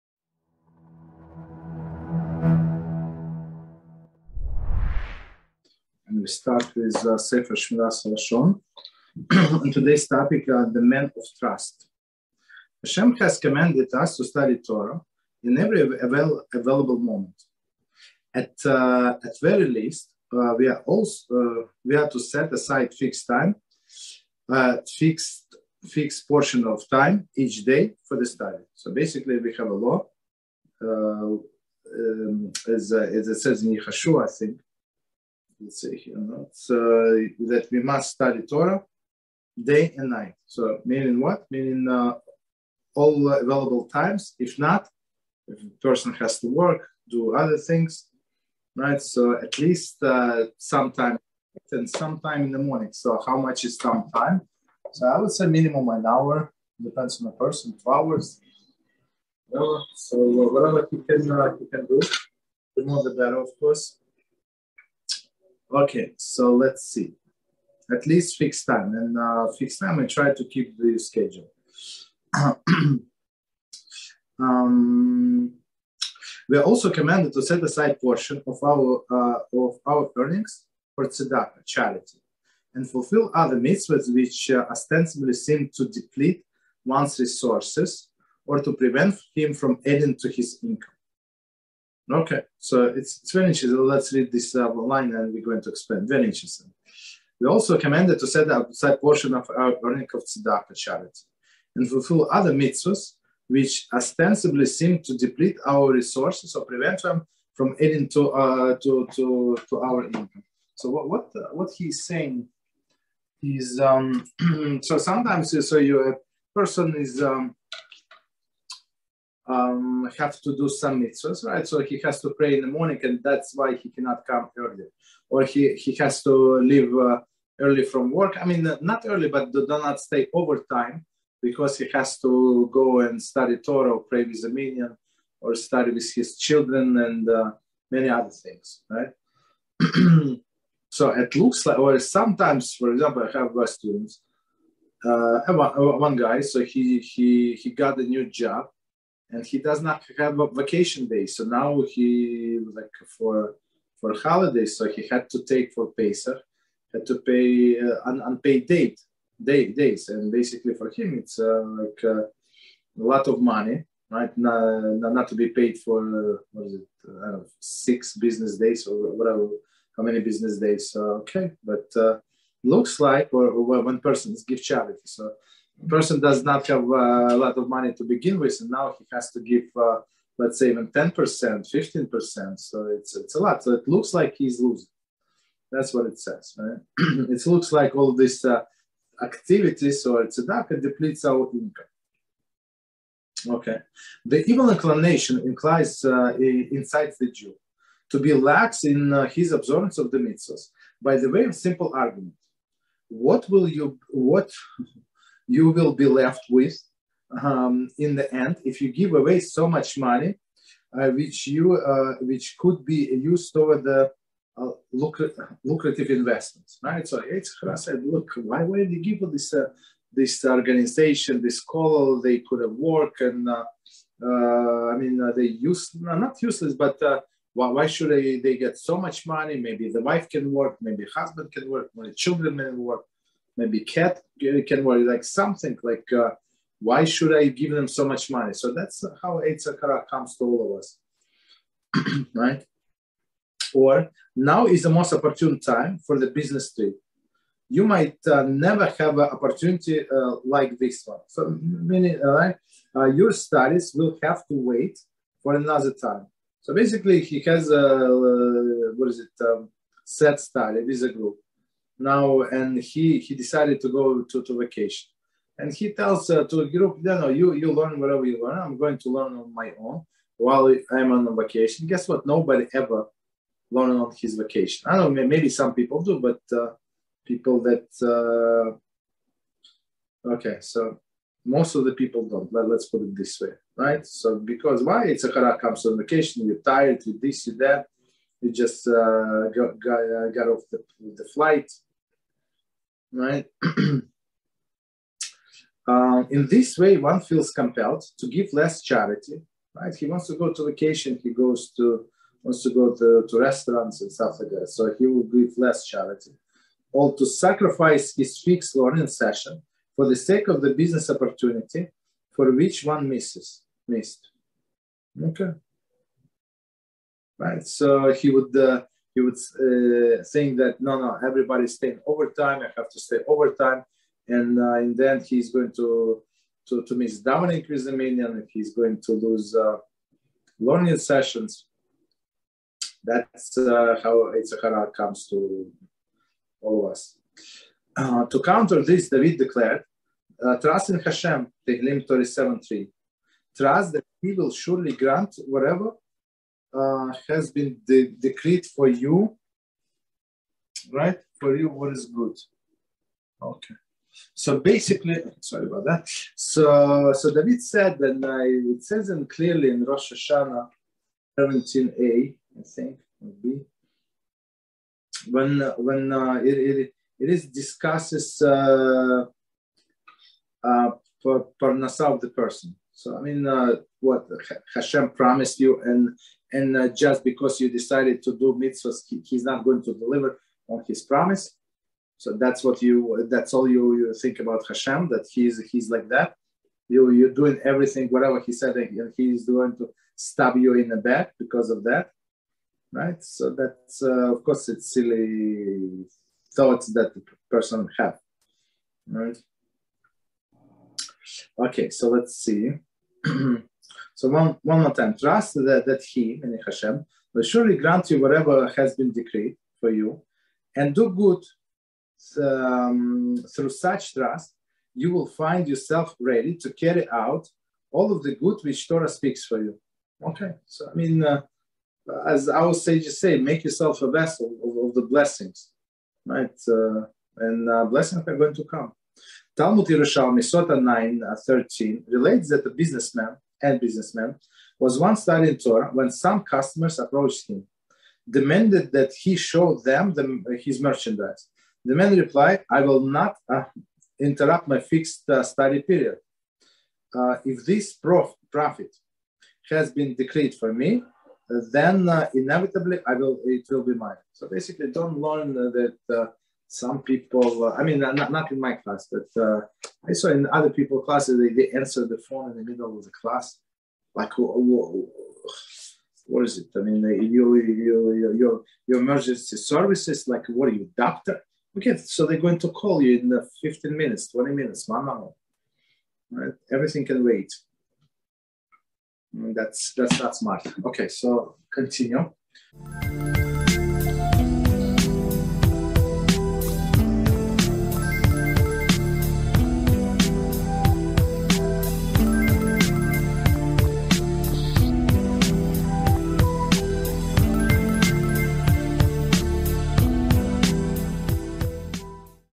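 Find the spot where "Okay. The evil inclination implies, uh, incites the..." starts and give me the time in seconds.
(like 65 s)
193 s.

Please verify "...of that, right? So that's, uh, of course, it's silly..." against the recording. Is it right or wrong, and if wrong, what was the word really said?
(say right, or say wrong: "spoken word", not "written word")
right.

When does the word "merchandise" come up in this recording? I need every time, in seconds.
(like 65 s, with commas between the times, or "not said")
440 s.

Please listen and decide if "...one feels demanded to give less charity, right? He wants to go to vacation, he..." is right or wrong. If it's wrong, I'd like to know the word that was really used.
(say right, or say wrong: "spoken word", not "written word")
wrong: "compelled", not "demanded".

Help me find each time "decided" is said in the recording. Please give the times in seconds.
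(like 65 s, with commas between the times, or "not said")
263 s, 377 s.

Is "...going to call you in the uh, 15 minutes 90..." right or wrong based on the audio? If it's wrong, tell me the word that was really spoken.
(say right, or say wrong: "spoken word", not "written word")
wrong: "20", not "90".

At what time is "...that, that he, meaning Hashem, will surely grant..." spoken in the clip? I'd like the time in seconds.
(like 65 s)
405 s.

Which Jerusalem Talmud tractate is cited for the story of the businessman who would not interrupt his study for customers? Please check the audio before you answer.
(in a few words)
Sota.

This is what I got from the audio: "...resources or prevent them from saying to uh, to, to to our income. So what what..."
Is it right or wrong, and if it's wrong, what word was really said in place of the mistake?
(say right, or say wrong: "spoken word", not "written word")
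wrong: "adding", not "saying".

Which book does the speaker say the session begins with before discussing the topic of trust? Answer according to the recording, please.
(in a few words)
Sefer Shmiras Lashon.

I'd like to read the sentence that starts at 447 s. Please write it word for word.
Uh, if this prof- profit has been decreed for me, then uh, inevitably I will it will be mine.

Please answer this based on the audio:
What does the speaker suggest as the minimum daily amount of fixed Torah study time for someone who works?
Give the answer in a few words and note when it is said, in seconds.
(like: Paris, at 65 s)
an hour, at 55 s.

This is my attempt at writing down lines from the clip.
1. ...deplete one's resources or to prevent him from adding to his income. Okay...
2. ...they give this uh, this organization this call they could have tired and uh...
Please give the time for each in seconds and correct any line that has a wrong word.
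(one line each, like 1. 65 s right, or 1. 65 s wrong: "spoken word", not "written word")
1. 85 s right
2. 218 s wrong: "worked", not "tired".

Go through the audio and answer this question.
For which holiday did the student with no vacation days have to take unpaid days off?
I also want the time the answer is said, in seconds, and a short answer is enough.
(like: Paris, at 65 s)
Pesach, at 155 s.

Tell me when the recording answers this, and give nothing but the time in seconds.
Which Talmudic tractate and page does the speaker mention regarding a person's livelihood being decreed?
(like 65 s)
359 s.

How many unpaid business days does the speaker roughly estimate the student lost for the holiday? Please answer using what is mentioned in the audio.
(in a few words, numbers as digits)
6.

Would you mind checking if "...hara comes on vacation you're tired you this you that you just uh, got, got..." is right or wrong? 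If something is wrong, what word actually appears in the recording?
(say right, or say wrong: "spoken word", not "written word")
right.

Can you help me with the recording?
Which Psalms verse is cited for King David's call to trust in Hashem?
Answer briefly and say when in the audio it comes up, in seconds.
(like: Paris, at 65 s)
Tehillim 37:3, at 341 s.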